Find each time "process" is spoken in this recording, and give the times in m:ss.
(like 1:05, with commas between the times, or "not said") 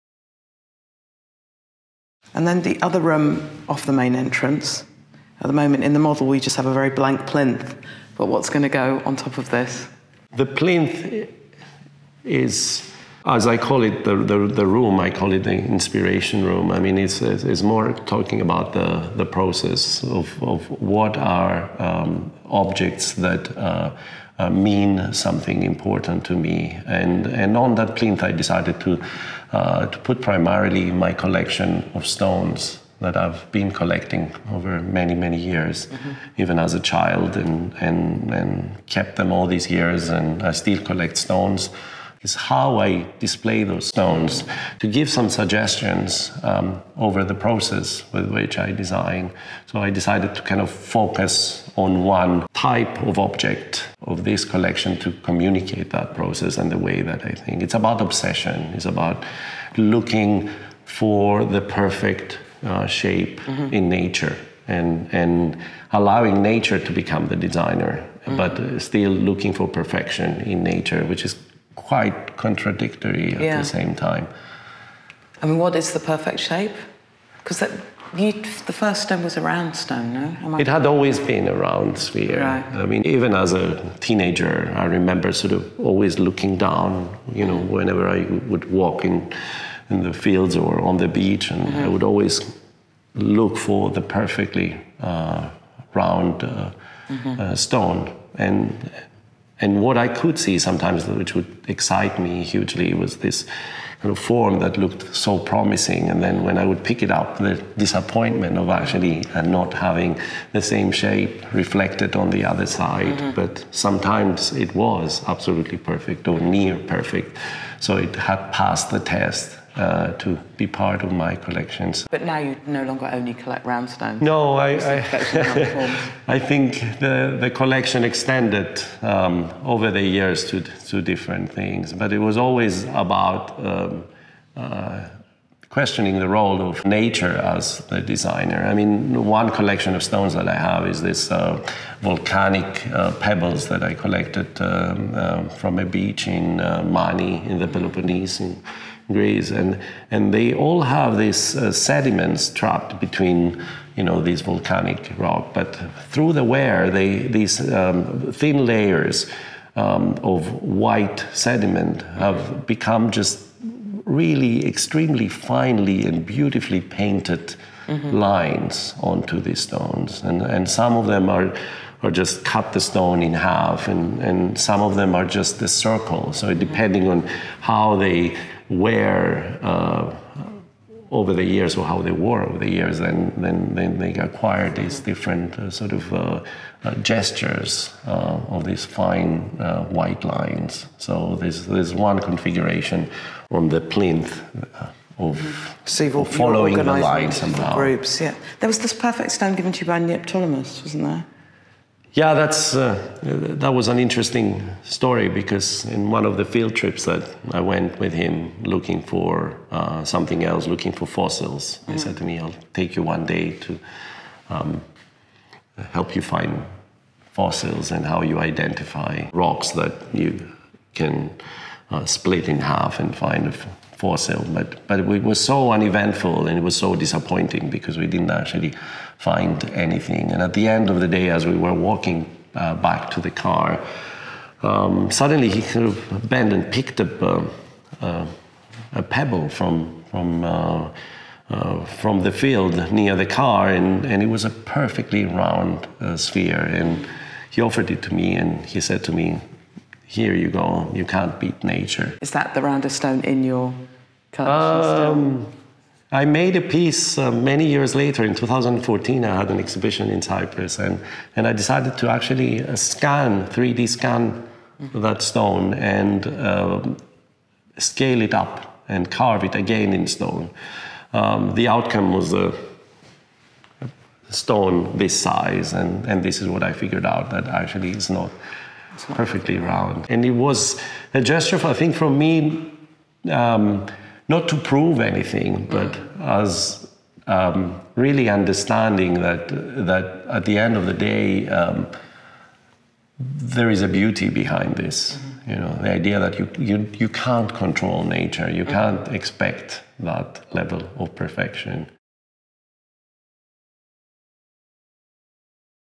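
0:19, 0:47, 0:56.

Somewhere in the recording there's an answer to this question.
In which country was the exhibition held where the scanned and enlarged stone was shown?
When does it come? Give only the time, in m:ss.
4:20.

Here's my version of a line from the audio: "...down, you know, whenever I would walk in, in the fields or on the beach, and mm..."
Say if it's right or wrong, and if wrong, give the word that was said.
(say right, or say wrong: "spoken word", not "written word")
right.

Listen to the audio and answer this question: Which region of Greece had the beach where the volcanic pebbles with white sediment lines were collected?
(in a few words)
Mani.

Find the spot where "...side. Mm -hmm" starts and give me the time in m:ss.
1:52.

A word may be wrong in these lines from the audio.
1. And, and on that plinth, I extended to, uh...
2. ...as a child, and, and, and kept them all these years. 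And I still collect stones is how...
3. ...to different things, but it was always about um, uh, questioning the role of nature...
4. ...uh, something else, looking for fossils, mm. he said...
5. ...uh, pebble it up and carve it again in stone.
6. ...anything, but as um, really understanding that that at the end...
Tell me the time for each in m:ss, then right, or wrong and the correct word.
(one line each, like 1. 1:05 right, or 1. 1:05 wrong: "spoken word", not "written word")
1. 0:26 wrong: "decided", not "extended"
2. 0:36 right
3. 2:10 right
4. 3:29 right
5. 4:26 wrong: "scale", not "pebble"
6. 4:45 right.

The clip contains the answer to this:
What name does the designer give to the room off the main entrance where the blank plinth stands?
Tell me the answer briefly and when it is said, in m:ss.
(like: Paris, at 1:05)
The inspiration room, at 0:15.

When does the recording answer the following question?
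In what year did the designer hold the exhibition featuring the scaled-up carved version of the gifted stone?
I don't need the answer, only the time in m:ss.
4:18.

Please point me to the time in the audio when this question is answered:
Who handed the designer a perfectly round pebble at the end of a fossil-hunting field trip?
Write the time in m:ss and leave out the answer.
3:19.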